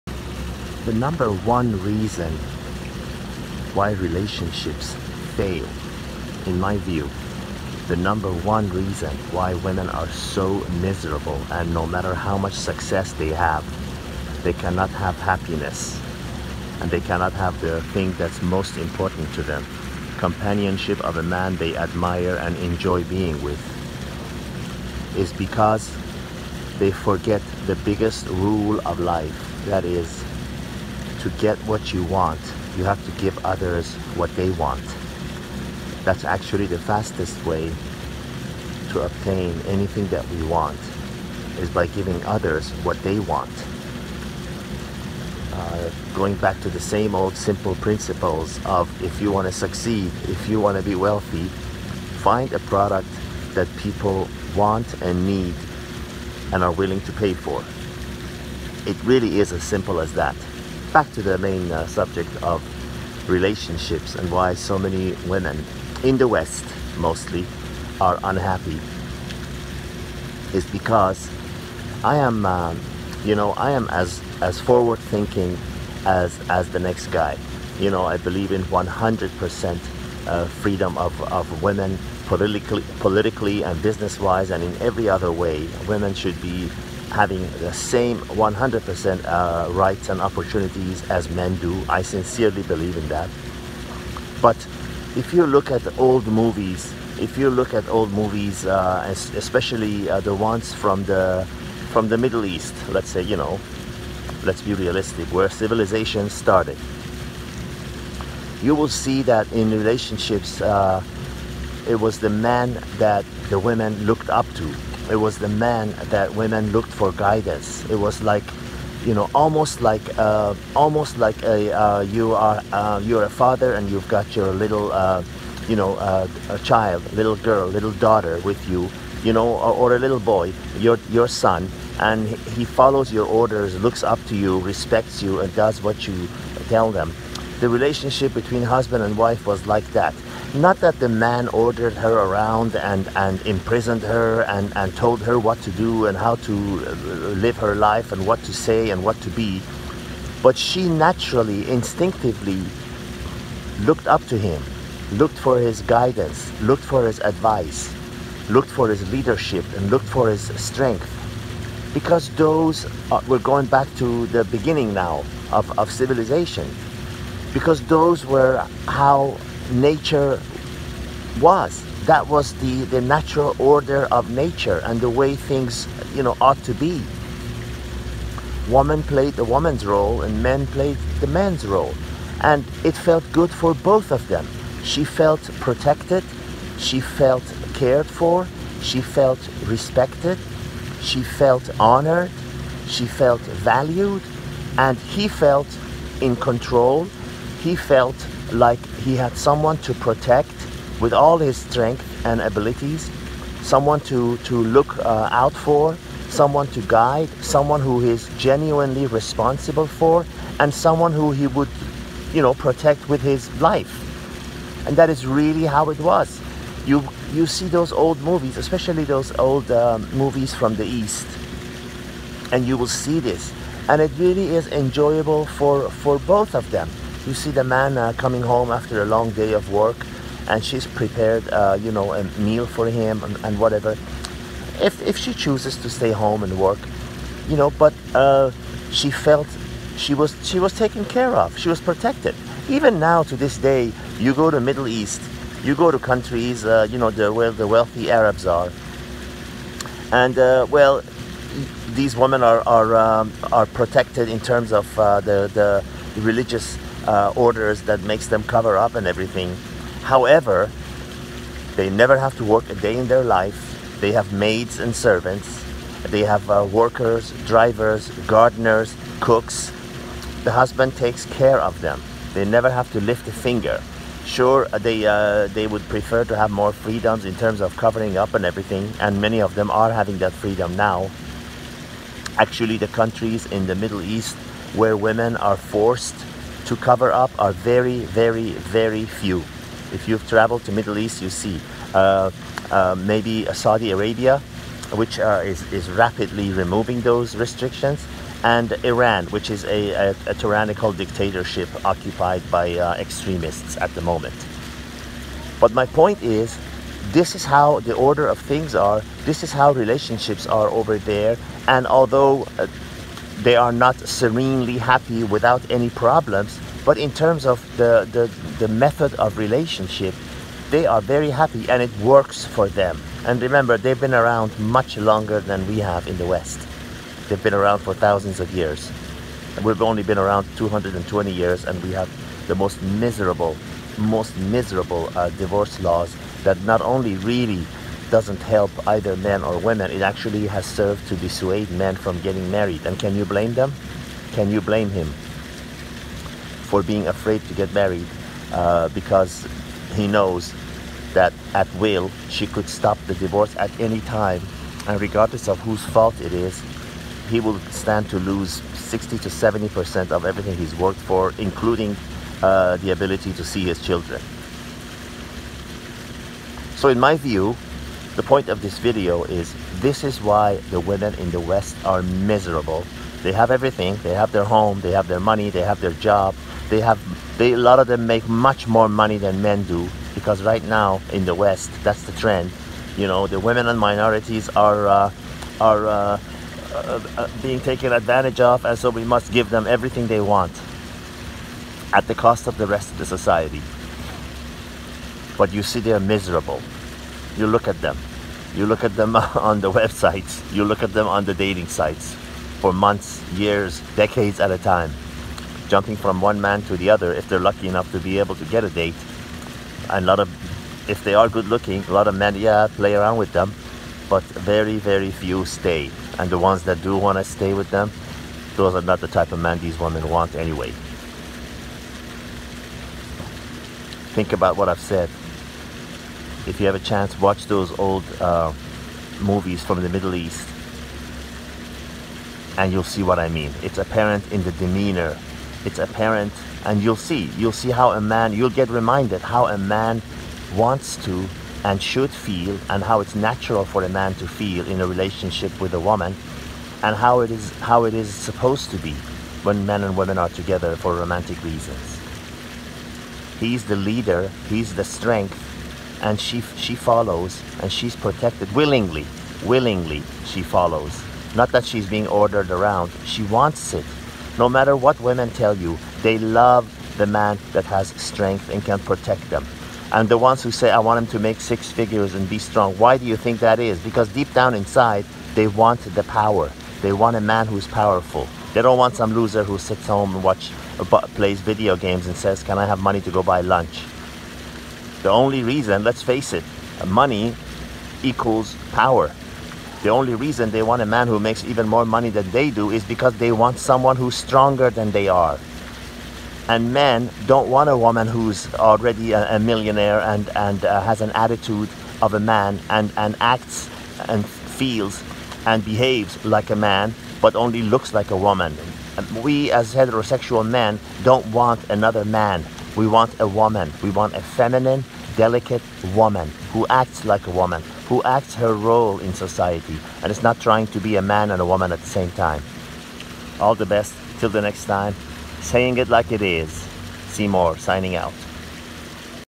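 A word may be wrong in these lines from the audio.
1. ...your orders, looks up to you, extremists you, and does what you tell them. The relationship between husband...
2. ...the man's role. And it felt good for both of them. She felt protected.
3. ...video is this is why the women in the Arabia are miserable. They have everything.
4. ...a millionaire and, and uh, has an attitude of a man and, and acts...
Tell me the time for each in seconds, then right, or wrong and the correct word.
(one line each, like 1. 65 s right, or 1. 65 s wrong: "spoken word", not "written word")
1. 133 s wrong: "respects", not "extremists"
2. 181 s right
3. 368 s wrong: "West", not "Arabia"
4. 499 s right.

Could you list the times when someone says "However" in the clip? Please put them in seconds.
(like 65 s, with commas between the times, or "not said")
260 s.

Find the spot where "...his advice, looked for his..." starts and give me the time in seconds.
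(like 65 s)
157 s.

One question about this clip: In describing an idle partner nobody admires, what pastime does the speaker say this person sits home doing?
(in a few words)
Plays video games.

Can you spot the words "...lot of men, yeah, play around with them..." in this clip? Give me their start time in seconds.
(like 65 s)
411 s.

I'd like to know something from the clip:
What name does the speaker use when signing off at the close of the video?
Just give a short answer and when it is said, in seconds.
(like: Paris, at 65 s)
Seymour, at 527 s.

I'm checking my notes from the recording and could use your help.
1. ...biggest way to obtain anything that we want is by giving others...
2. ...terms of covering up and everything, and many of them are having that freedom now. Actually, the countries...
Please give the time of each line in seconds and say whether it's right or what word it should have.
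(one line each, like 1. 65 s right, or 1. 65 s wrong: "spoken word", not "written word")
1. 36 s wrong: "fastest", not "biggest"
2. 277 s right.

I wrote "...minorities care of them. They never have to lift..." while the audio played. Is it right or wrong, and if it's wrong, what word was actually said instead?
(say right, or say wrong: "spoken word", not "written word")
wrong: "takes", not "minorities".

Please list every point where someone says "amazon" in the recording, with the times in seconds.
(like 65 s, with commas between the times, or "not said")
not said.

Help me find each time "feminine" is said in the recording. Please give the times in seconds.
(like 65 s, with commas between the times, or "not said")
514 s.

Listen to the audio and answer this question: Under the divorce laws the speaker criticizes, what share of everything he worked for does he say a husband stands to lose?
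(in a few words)
60 to 70 percent.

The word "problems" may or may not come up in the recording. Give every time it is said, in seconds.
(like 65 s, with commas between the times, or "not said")
315 s.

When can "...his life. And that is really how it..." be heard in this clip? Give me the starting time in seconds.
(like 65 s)
213 s.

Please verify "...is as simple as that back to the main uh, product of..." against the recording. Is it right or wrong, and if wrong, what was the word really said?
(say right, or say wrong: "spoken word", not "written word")
wrong: "subject", not "product".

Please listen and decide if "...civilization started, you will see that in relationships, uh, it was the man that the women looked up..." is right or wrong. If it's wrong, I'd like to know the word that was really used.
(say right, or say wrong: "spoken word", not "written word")
right.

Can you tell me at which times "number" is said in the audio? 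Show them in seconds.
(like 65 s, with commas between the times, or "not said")
0 s, 7 s.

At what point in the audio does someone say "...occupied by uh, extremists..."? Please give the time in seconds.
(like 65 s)
301 s.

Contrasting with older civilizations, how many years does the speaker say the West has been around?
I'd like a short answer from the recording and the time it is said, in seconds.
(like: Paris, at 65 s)
220 years, at 330 s.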